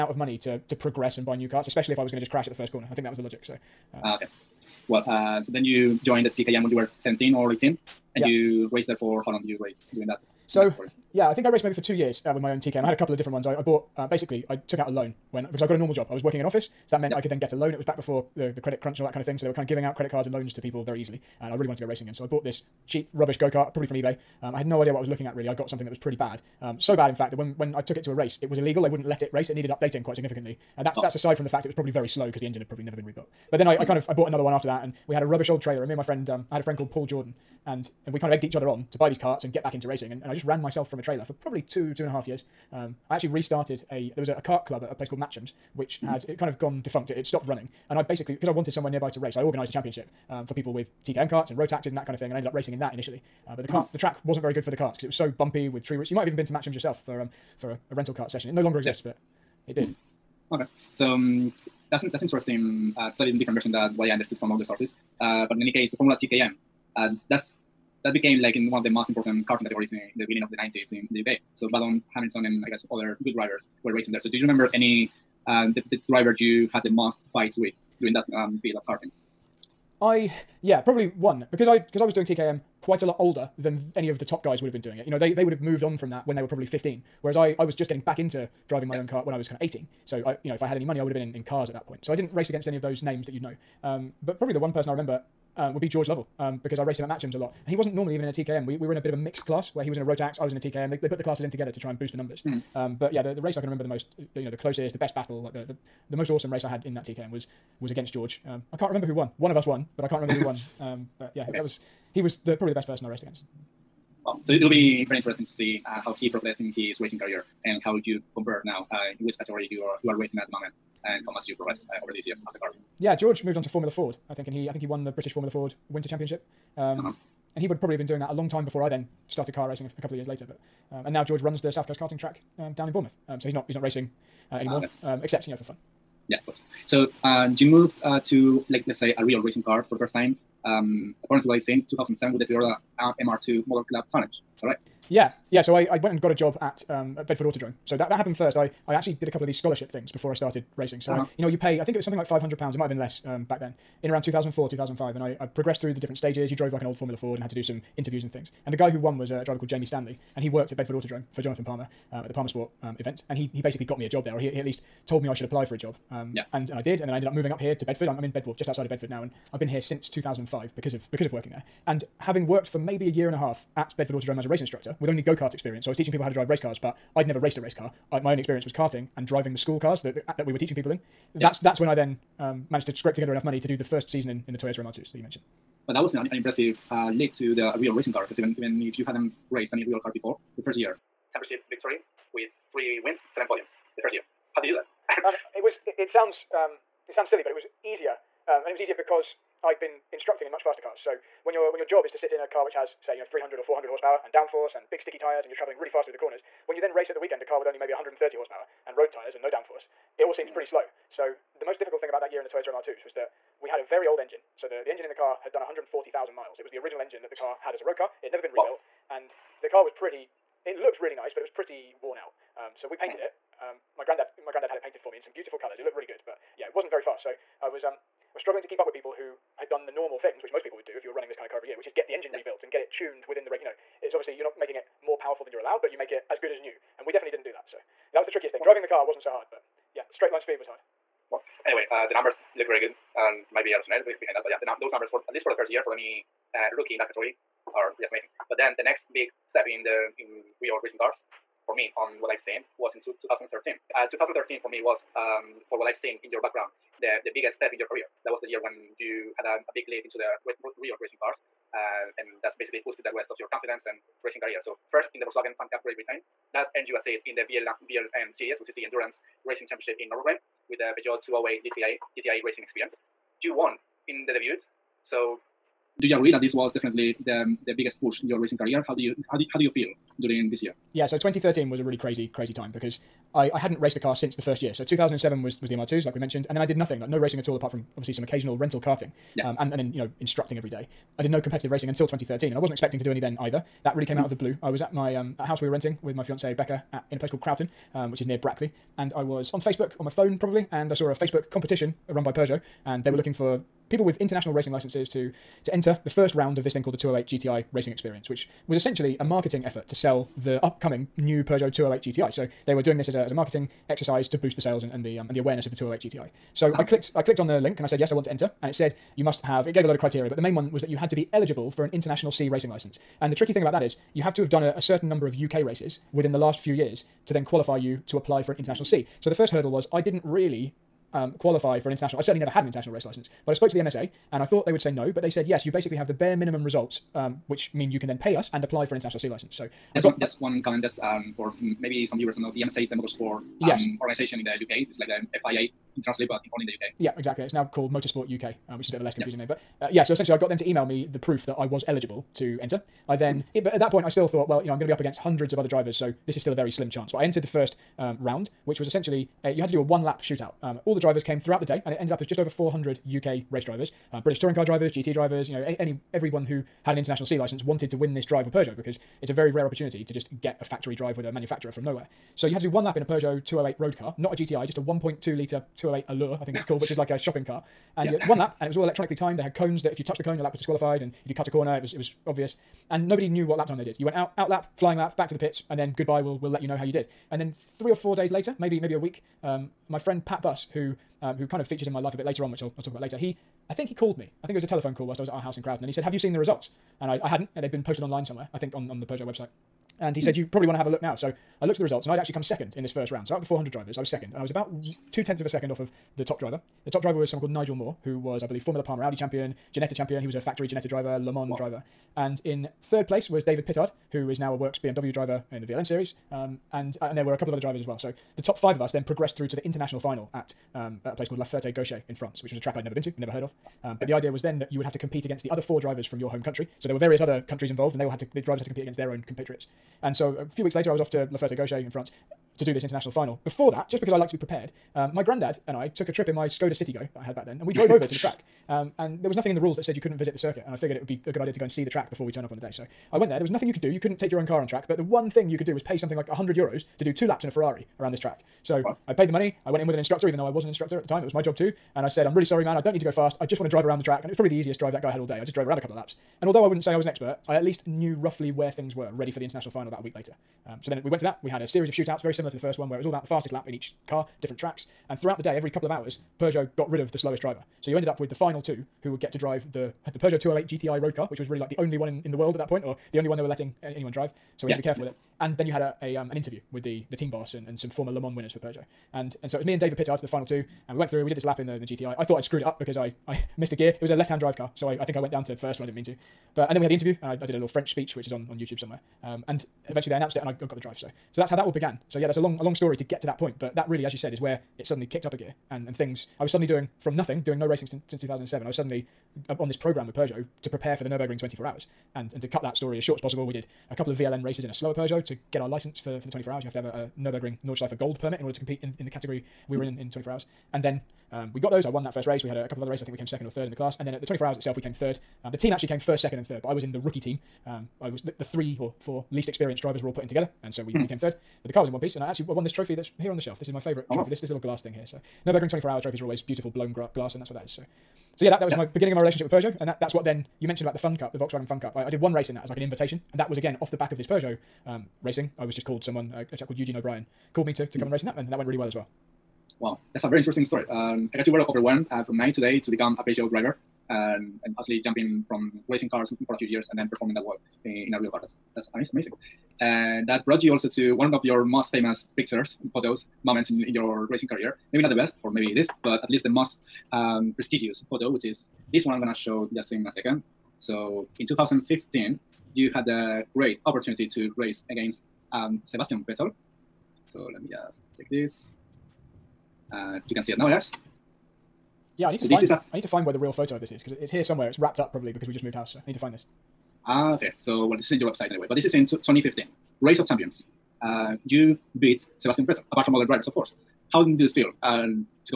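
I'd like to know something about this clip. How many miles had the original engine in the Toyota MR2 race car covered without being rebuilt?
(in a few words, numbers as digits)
140,000.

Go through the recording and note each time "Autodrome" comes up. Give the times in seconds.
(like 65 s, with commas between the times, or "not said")
147 s, 160 s, 174 s.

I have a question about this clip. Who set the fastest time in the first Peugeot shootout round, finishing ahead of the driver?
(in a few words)
Nigel Moore.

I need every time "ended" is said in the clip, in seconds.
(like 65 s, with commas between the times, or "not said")
52 s, 167 s, 361 s, 467 s.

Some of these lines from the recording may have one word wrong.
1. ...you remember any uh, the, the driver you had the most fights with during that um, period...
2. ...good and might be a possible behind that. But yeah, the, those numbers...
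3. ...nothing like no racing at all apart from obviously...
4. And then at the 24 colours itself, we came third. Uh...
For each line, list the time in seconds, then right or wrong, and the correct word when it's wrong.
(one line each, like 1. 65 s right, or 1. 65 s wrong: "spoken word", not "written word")
1. 74 s right
2. 242 s wrong: "rationale", not "possible"
3. 286 s right
4. 513 s wrong: "hours", not "colours".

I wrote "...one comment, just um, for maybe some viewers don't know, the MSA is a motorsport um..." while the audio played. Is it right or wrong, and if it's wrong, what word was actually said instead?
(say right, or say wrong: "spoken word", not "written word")
right.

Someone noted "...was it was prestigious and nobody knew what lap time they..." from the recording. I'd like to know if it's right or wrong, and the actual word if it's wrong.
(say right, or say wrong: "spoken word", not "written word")
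wrong: "obvious", not "prestigious".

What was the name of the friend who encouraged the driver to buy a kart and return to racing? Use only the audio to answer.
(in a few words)
Paul Jordan.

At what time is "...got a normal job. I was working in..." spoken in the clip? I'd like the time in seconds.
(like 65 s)
15 s.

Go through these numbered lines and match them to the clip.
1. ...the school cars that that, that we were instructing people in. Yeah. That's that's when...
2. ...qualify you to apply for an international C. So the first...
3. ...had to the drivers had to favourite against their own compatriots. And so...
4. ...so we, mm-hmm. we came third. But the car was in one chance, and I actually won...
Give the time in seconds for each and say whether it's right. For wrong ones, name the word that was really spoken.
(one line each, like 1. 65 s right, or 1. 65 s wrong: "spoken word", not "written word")
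1. 179 s wrong: "teaching", not "instructing"
2. 327 s right
3. 428 s wrong: "compete", not "favourite"
4. 520 s wrong: "piece", not "chance".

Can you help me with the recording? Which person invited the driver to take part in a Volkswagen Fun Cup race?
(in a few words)
Eugene O'Brien.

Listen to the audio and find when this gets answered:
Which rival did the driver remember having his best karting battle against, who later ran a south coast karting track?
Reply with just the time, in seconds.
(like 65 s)
95 s.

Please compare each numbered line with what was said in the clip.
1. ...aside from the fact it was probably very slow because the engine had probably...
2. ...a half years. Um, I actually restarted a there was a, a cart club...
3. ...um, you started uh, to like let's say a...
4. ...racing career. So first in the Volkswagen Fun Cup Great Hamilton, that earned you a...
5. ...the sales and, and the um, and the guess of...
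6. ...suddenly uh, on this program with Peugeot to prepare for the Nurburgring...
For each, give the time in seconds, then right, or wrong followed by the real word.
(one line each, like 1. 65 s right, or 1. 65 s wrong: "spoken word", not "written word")
1. 31 s right
2. 42 s right
3. 137 s wrong: "moved", not "started"
4. 264 s wrong: "Britain", not "Hamilton"
5. 314 s wrong: "awareness", not "guess"
6. 498 s right.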